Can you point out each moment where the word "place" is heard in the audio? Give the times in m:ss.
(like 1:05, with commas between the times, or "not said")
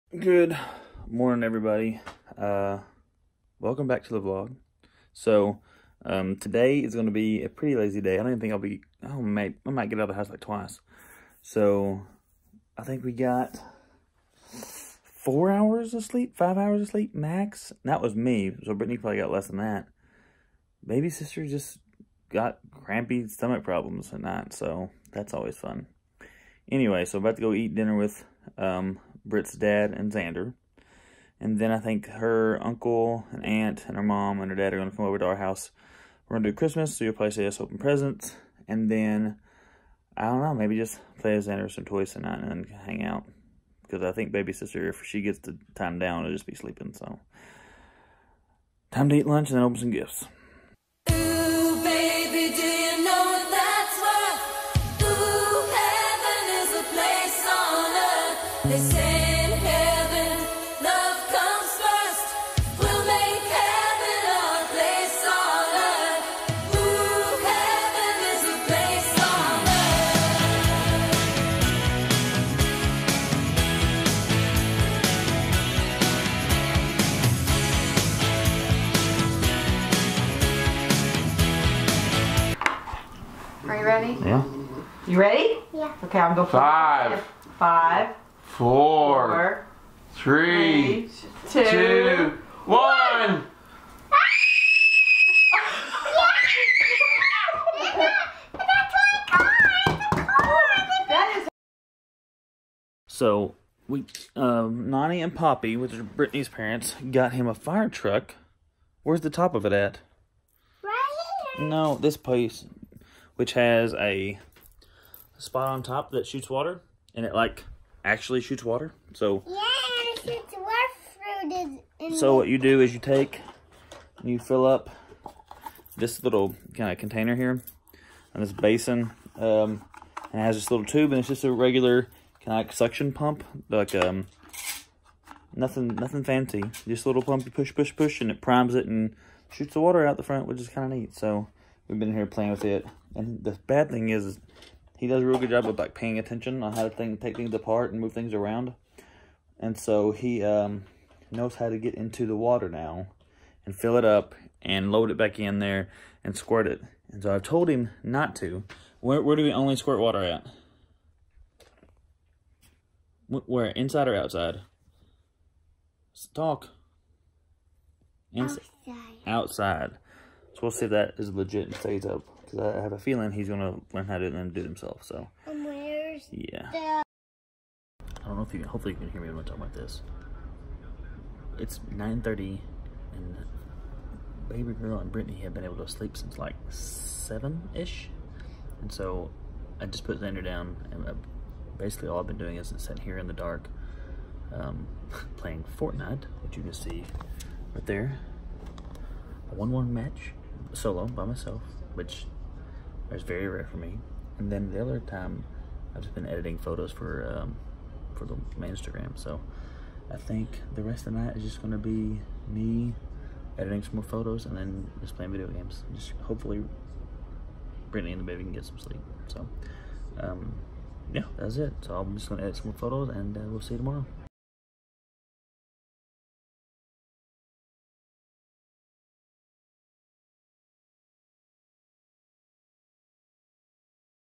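1:52.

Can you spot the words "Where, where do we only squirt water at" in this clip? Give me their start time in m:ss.
2:38.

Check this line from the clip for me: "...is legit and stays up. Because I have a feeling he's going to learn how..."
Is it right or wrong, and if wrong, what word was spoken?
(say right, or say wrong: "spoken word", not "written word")
right.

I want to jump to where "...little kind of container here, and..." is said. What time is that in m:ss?
2:06.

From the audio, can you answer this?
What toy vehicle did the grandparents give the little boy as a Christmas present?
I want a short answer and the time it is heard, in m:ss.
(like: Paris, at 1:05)
Fire truck, at 1:47.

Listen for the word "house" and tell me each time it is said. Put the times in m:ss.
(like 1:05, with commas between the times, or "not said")
0:10, 0:35.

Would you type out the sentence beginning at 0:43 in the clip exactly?
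Because I think baby sister, if she gets the time down, will just be sleeping.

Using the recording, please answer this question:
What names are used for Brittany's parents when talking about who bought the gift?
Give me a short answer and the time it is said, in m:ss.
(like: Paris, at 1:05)
Nani and Poppy, at 1:44.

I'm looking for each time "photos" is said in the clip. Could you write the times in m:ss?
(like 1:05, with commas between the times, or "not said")
3:26, 3:34, 3:42.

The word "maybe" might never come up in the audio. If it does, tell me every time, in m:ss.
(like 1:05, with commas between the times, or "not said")
0:40.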